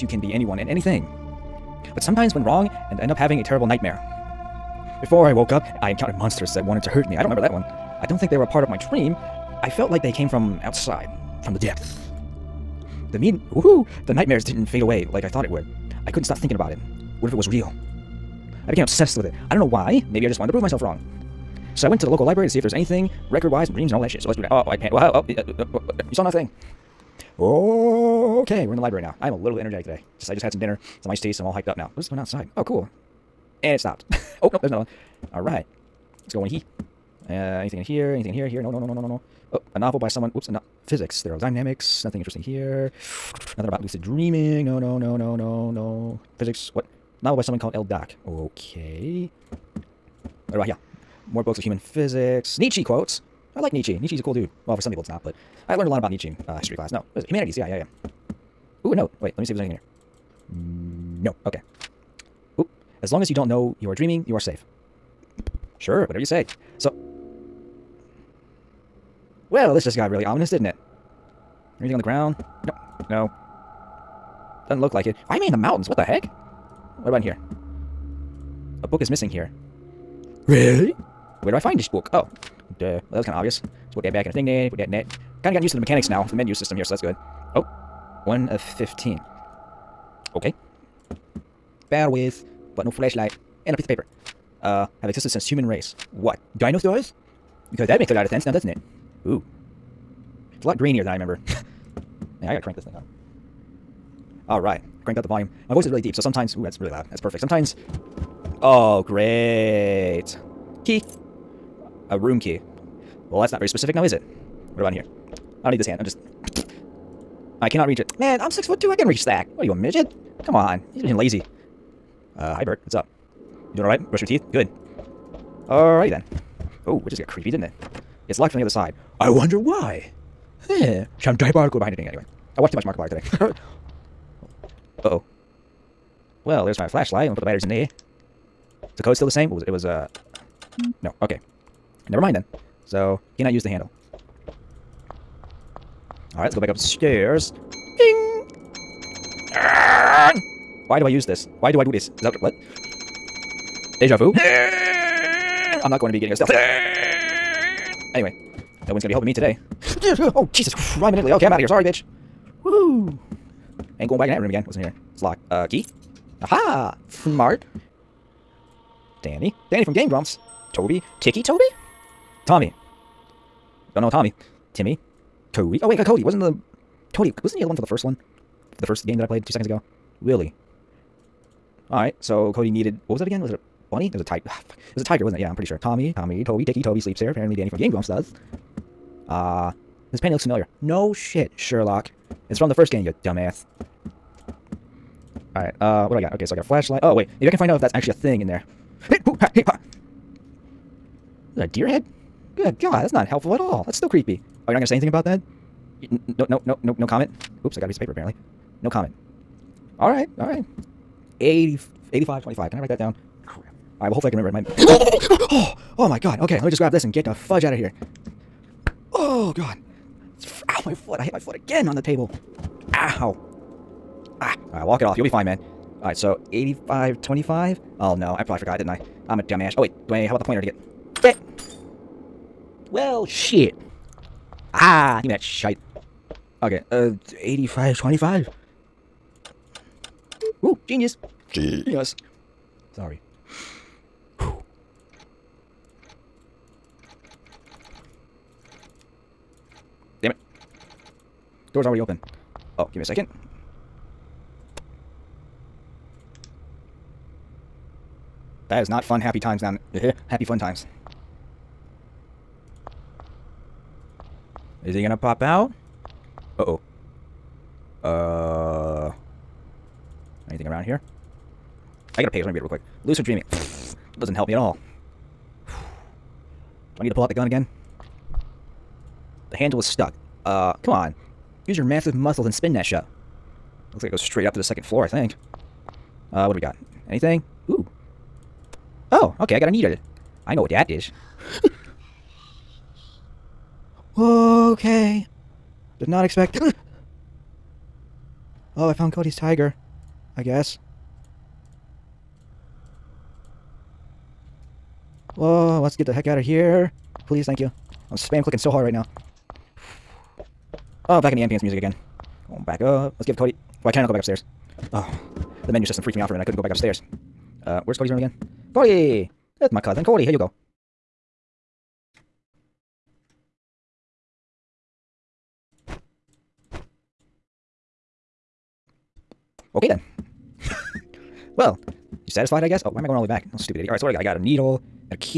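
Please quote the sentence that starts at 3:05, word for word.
Tommy, Tommy, Toby, Tiki, Toby sleeps here.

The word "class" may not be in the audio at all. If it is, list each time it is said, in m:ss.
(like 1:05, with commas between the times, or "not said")
0:56.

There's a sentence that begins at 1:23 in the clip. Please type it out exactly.
Let's put that back in a thing there, put that in that.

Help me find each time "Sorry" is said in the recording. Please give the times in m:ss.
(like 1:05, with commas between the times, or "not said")
2:41, 4:02.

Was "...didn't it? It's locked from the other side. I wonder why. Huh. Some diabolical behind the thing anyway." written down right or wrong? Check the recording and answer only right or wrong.
right.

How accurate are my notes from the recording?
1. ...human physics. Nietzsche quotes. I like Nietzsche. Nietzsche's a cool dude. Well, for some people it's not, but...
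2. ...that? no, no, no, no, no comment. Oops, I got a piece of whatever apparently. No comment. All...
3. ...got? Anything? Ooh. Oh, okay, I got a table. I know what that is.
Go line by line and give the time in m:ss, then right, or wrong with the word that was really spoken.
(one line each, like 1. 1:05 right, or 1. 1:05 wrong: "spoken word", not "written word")
1. 0:51 right
2. 3:25 wrong: "paper", not "whatever"
3. 4:46 wrong: "needle", not "table".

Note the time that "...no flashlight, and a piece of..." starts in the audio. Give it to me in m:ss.
1:32.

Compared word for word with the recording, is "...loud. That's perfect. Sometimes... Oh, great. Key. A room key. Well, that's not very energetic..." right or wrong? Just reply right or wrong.
wrong.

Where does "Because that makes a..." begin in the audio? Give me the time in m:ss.
1:37.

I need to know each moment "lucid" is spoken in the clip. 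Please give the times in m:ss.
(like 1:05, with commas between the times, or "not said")
0:43, 4:33.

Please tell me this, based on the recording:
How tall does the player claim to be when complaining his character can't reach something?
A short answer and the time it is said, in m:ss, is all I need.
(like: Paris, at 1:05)
6'2", at 1:58.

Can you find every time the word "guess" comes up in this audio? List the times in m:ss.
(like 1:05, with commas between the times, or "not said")
5:00, 5:32.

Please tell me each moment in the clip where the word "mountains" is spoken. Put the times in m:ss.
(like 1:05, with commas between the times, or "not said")
1:15.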